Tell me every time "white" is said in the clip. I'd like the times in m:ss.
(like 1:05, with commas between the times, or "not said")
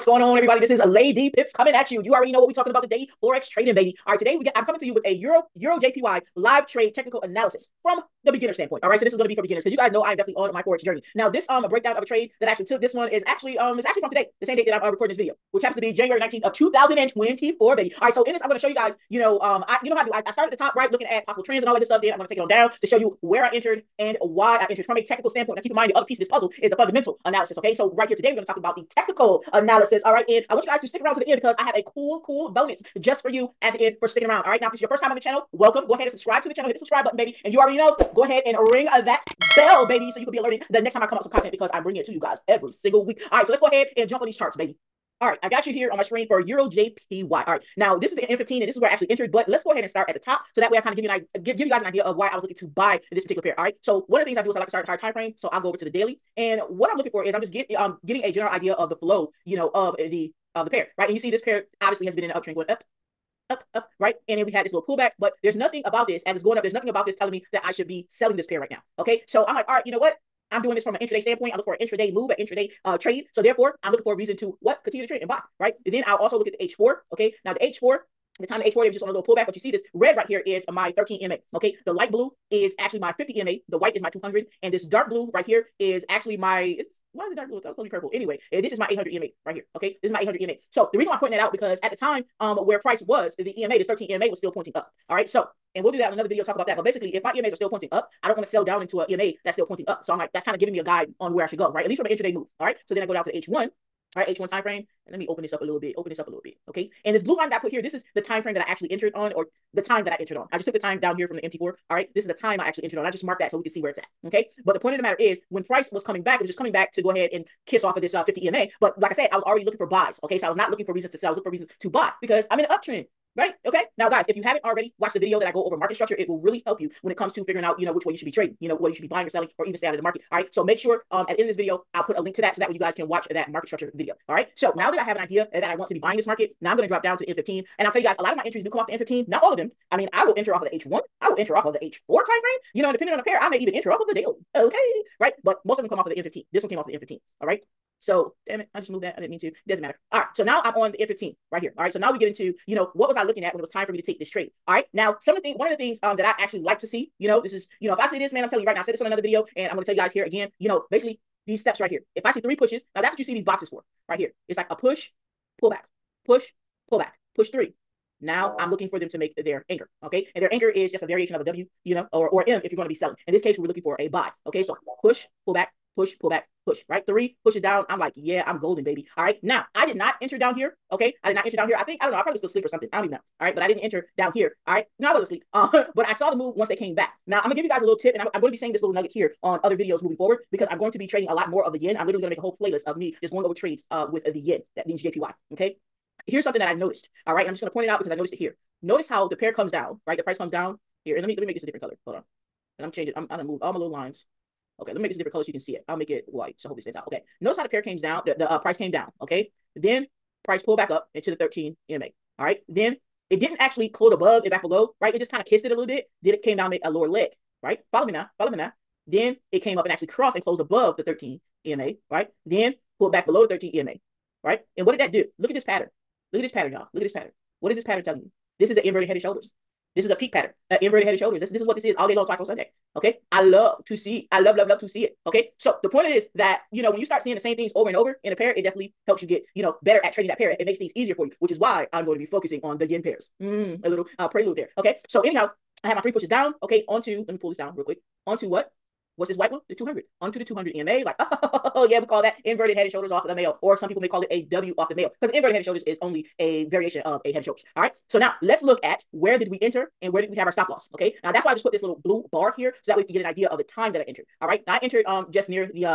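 1:23, 3:26, 4:09.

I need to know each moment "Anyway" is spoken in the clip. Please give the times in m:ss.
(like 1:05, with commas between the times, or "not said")
1:28.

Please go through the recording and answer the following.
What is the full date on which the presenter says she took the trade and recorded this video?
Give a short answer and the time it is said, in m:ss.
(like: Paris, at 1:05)
January 19, 2024, at 0:15.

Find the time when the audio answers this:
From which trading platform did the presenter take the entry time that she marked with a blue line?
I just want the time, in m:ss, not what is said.
1:51.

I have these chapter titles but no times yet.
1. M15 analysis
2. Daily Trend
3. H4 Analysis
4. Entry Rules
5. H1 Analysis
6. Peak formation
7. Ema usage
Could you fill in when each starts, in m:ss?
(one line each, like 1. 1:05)
1. 2:29
2. 1:01
3. 1:17
4. 2:46
5. 2:09
6. 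3:36
7. 1:34.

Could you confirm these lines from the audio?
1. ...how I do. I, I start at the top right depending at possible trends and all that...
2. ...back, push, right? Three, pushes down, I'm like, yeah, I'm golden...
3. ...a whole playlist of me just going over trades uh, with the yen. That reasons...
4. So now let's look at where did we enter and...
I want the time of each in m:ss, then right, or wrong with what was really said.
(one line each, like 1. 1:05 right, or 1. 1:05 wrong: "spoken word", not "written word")
1. 0:19 wrong: "looking", not "depending"
2. 2:56 right
3. 3:12 wrong: "means", not "reasons"
4. 4:18 right.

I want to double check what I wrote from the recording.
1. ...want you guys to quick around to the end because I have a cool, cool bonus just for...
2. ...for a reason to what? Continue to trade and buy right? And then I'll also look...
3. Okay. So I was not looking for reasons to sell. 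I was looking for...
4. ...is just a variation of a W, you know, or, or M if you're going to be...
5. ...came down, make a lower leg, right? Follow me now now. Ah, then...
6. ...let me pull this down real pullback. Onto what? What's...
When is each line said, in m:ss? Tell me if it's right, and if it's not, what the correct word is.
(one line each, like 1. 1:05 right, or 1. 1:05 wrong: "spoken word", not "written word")
1. 0:30 wrong: "stick", not "quick"
2. 1:14 right
3. 2:00 right
4. 2:50 right
5. 3:36 right
6. 4:07 wrong: "quick", not "pullback".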